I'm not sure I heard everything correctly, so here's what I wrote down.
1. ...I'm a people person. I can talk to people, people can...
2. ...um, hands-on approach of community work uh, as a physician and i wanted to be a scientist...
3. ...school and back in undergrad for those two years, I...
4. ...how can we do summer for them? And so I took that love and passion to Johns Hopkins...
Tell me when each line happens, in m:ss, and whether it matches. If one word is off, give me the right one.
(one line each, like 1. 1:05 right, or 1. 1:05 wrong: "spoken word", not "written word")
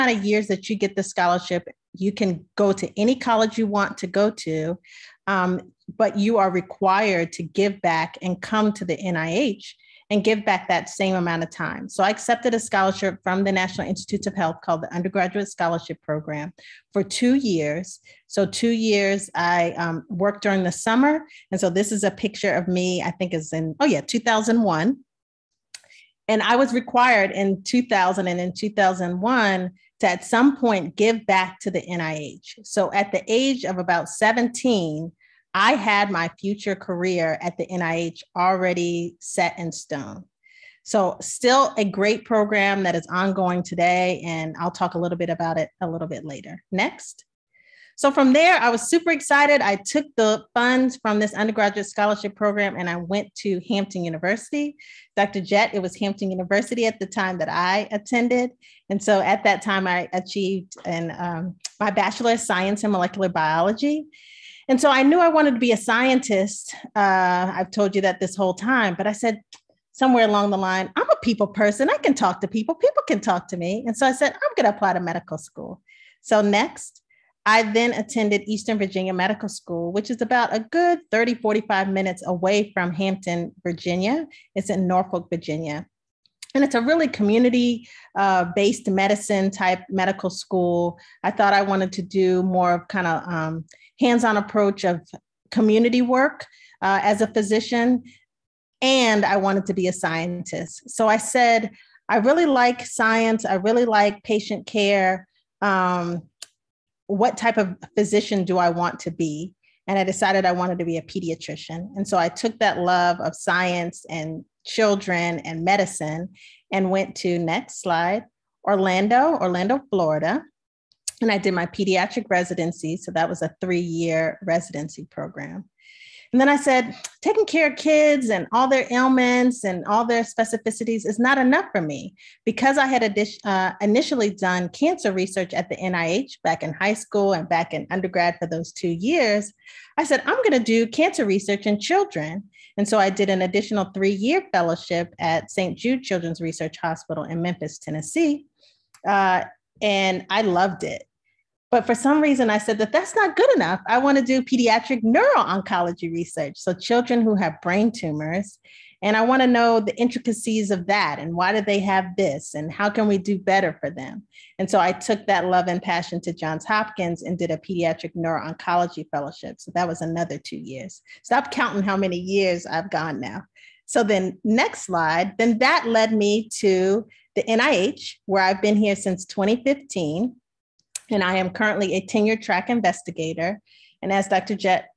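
1. 1:10 right
2. 1:33 right
3. 2:16 right
4. 2:42 wrong: "better", not "summer".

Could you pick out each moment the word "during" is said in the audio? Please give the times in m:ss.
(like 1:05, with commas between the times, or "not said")
0:20.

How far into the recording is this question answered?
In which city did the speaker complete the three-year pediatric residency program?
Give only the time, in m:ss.
1:59.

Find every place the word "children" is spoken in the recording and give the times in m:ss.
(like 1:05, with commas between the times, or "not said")
1:54, 2:21, 2:26, 2:36.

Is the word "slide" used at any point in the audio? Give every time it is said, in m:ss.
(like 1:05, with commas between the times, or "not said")
1:57, 2:54.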